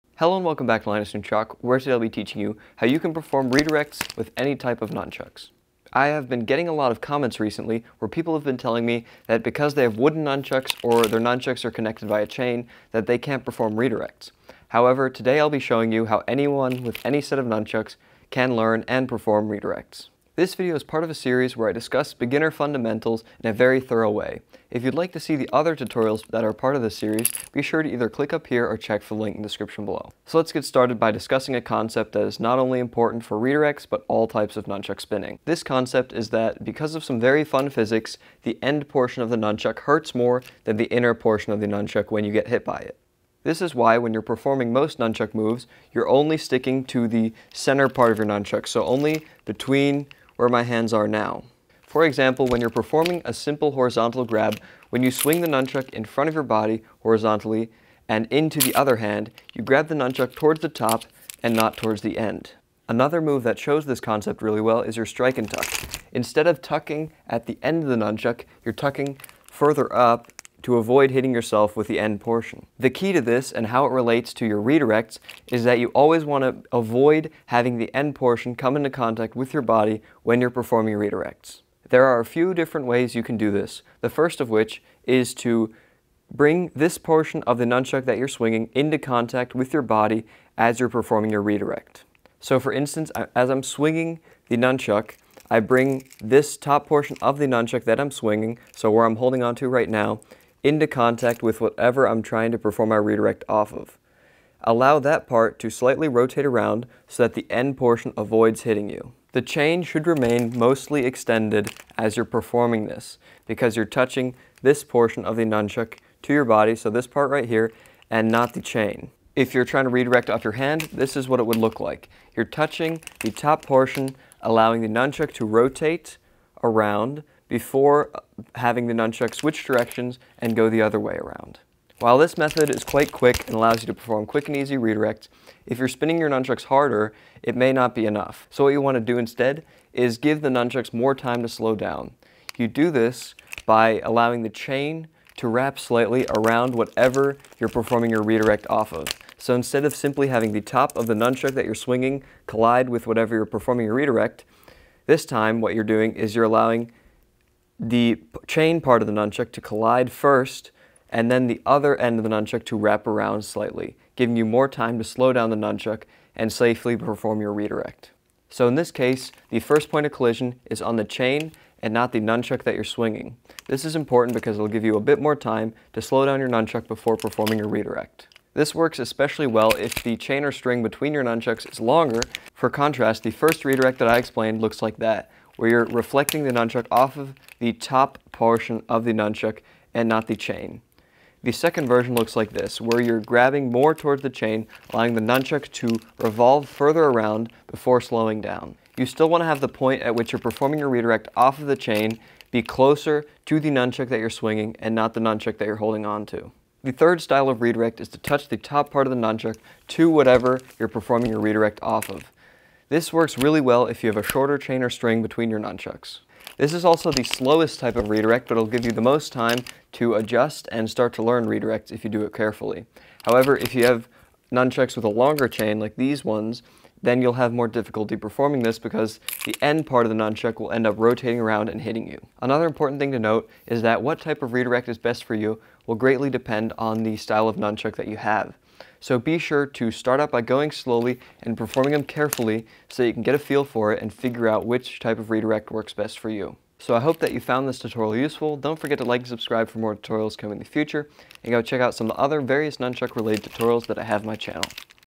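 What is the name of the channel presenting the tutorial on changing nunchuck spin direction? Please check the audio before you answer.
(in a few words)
Linus Nunchaku.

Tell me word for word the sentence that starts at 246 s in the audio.
So I hope that you found this tutorial useful.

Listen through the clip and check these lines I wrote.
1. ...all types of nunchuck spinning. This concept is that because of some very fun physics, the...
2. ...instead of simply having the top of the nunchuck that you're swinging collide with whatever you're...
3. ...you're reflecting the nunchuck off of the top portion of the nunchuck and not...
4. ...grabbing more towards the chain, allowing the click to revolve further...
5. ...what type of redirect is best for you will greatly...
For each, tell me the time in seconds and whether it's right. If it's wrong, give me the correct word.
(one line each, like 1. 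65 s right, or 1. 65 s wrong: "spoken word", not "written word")
1. 34 s right
2. 149 s right
3. 185 s right
4. 193 s wrong: "nunchuck", not "click"
5. 234 s right.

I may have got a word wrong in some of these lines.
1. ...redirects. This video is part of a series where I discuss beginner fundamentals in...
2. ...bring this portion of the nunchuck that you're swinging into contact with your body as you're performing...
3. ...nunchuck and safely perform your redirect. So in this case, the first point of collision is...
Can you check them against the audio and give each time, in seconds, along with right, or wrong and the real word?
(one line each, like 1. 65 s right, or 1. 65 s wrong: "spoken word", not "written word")
1. 19 s right
2. 86 s right
3. 165 s right.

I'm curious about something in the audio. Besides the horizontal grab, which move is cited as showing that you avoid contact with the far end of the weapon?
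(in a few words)
strike and tuck.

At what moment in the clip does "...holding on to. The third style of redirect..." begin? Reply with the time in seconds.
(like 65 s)
205 s.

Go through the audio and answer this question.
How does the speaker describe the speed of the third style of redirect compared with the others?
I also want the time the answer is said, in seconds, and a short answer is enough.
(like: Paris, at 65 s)
the slowest, at 217 s.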